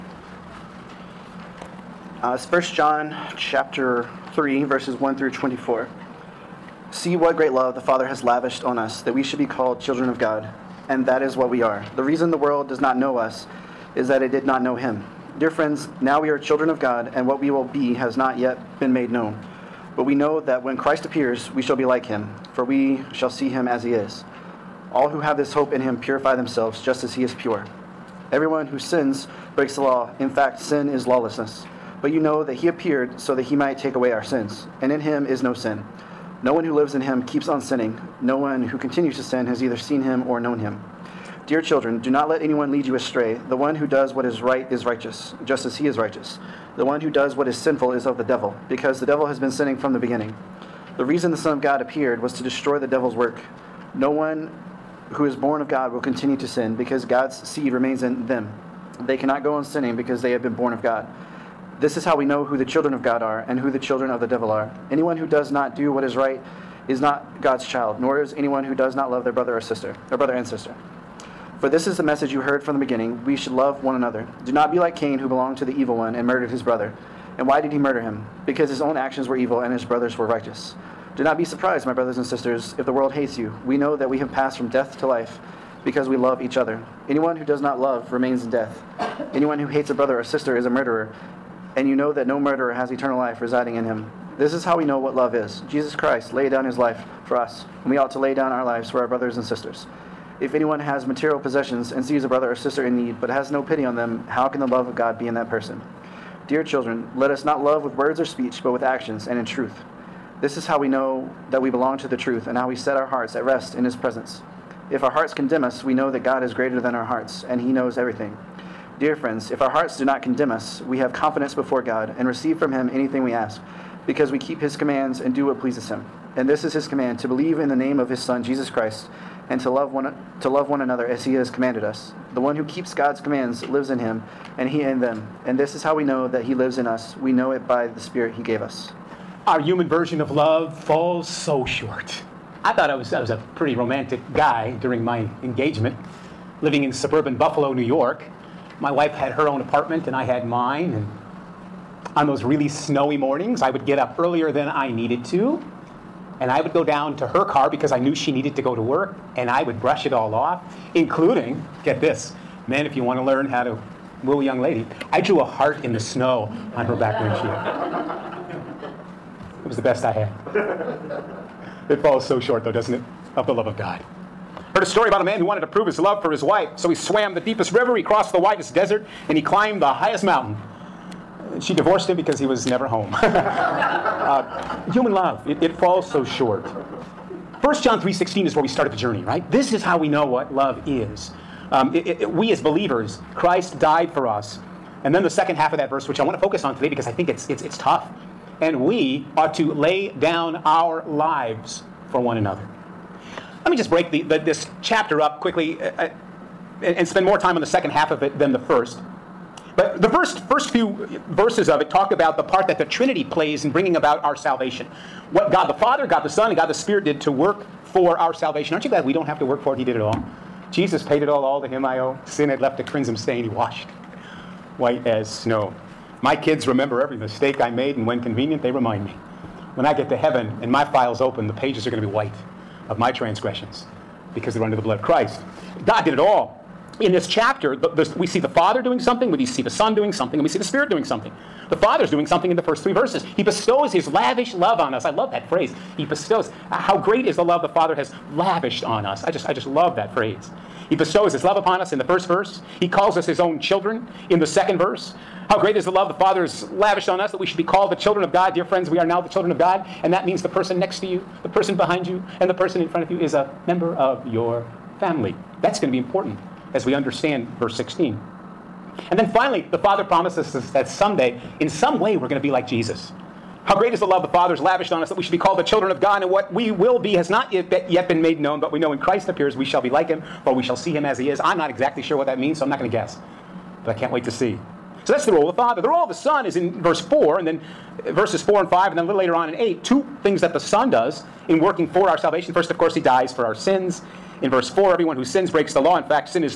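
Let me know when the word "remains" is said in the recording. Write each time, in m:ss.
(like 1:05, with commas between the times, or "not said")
0:57, 1:28.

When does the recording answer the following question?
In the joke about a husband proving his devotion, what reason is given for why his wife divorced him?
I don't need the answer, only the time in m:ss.
3:02.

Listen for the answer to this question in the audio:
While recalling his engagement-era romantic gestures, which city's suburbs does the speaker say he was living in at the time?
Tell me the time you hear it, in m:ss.
2:27.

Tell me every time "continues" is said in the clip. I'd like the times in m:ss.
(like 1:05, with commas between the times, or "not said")
0:38, 0:55.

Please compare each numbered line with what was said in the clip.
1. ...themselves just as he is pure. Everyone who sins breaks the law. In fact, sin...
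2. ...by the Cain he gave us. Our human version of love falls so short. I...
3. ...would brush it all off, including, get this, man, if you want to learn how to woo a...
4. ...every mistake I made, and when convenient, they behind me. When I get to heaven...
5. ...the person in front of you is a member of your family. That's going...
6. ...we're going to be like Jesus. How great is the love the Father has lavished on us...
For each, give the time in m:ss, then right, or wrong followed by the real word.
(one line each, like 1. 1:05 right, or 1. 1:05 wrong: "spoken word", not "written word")
1. 0:26 right
2. 2:17 wrong: "Spirit", not "Cain"
3. 2:39 right
4. 3:47 wrong: "remind", not "behind"
5. 4:22 right
6. 4:32 right.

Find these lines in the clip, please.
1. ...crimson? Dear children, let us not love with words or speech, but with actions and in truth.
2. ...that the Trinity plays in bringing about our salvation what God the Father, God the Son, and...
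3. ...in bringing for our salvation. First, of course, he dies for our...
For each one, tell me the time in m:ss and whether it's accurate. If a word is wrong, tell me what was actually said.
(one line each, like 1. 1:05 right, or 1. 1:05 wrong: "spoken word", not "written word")
1. 1:45 wrong: "person", not "crimson"
2. 3:32 right
3. 4:51 wrong: "working", not "bringing".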